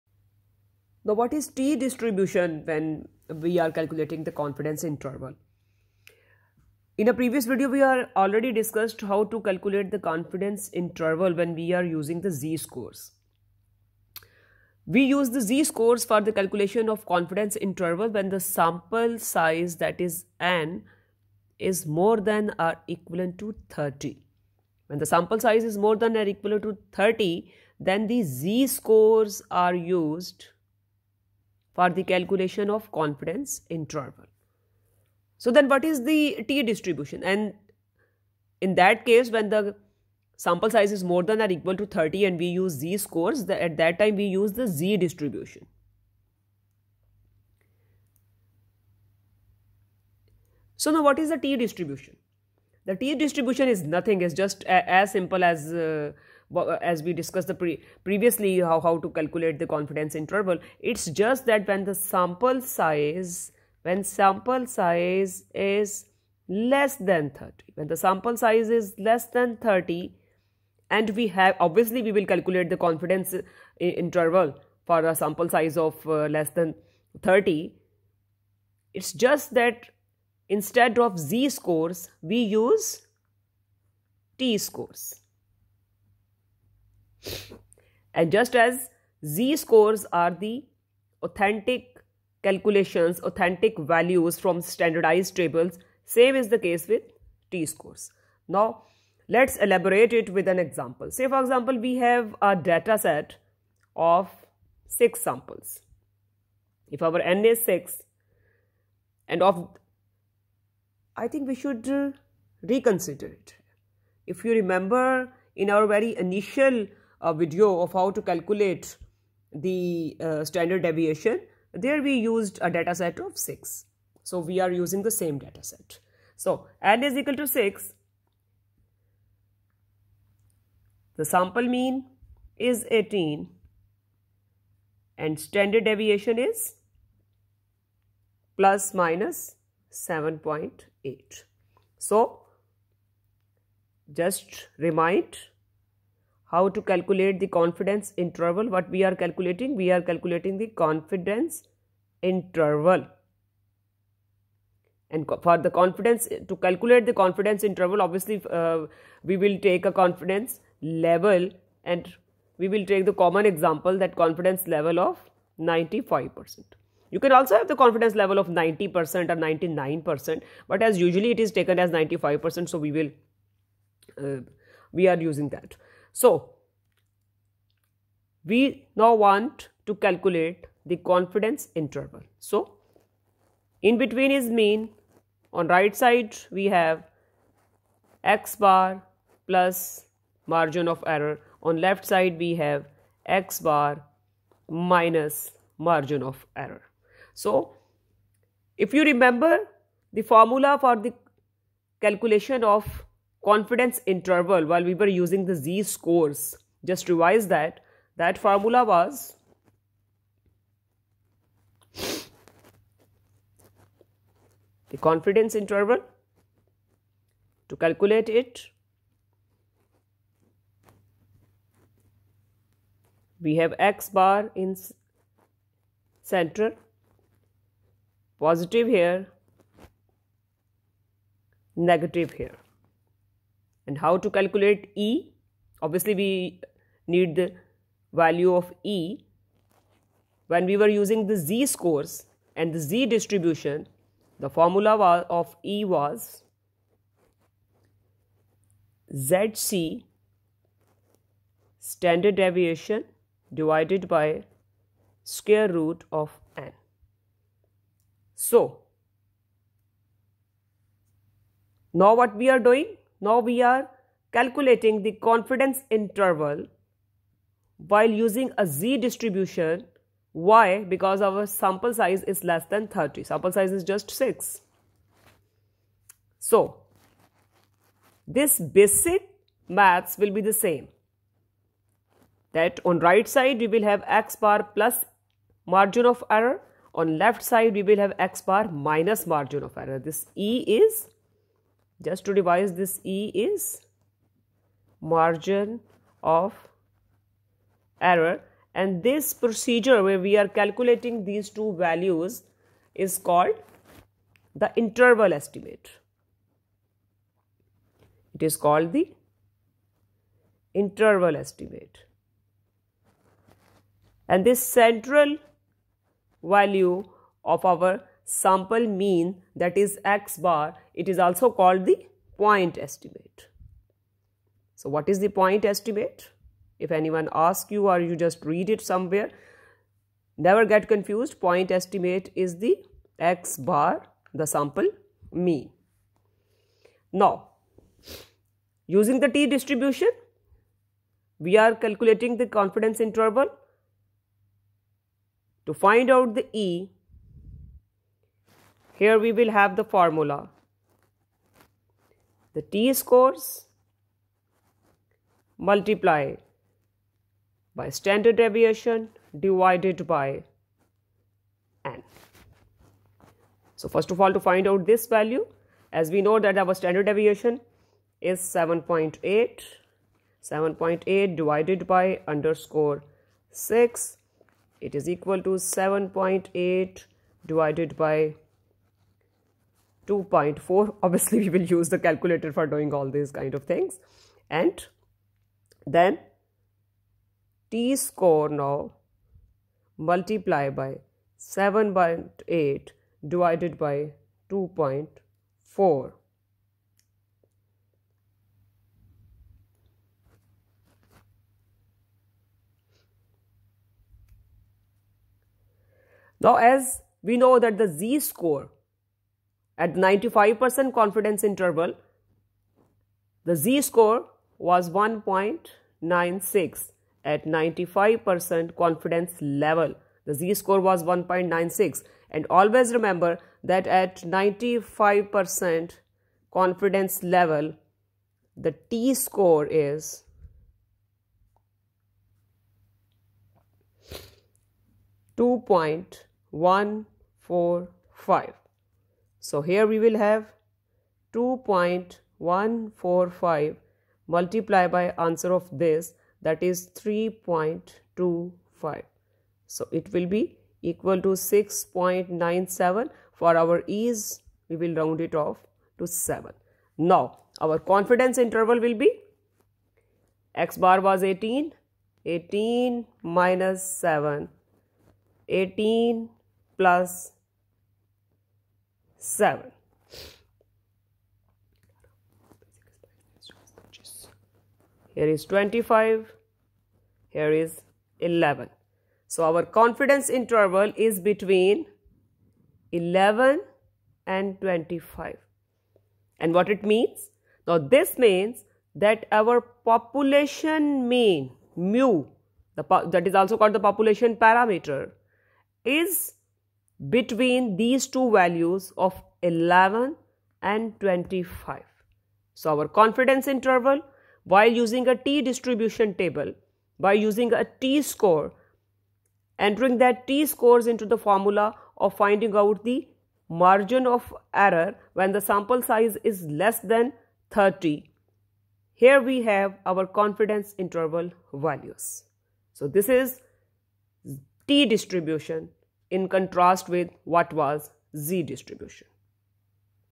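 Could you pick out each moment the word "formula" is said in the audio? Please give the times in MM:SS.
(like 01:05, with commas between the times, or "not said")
03:20, 03:28, 04:04, 05:49, 08:31.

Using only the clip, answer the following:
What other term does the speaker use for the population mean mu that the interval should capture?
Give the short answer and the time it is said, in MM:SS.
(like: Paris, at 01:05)
population parameter, at 08:13.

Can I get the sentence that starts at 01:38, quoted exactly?
Now, let's elaborate it with an example.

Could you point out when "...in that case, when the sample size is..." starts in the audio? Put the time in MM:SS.
00:38.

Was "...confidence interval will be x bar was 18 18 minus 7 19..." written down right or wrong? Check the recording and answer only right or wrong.
wrong.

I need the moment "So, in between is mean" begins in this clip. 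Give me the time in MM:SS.
03:02.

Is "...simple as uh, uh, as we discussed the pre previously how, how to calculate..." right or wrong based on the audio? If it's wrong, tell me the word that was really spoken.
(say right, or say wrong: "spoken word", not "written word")
right.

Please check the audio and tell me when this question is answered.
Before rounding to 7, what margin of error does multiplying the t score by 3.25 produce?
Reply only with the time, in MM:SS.
07:31.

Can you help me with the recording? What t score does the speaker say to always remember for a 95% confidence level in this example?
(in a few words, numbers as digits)
2.145.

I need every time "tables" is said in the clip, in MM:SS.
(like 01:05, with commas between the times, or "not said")
01:35, 08:26.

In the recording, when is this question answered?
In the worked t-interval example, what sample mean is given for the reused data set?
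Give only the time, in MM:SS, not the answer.
02:11.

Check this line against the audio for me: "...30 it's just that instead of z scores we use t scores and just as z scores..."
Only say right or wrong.
right.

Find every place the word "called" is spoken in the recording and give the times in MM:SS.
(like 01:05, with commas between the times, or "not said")
05:03, 05:08, 05:21, 08:13.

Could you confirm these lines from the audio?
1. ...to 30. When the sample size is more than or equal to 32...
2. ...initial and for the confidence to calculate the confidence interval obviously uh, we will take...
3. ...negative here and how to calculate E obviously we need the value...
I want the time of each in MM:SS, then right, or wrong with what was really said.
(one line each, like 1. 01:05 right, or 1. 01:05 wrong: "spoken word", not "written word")
1. 00:23 wrong: "30", not "32"
2. 02:32 wrong: "interval", not "initial"
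3. 03:51 right.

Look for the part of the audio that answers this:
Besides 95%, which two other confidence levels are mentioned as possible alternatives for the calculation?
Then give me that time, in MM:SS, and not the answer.
02:48.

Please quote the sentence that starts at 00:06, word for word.
In a previous video, we are already discussed how to calculate the confidence interval when we are using the z-scores.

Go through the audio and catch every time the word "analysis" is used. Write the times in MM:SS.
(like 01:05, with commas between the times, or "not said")
not said.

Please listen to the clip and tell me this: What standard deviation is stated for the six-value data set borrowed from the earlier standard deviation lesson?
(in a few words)
7.8.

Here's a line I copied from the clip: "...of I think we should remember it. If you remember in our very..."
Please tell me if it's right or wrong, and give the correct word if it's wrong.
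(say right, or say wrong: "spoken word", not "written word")
wrong: "reconsider", not "remember".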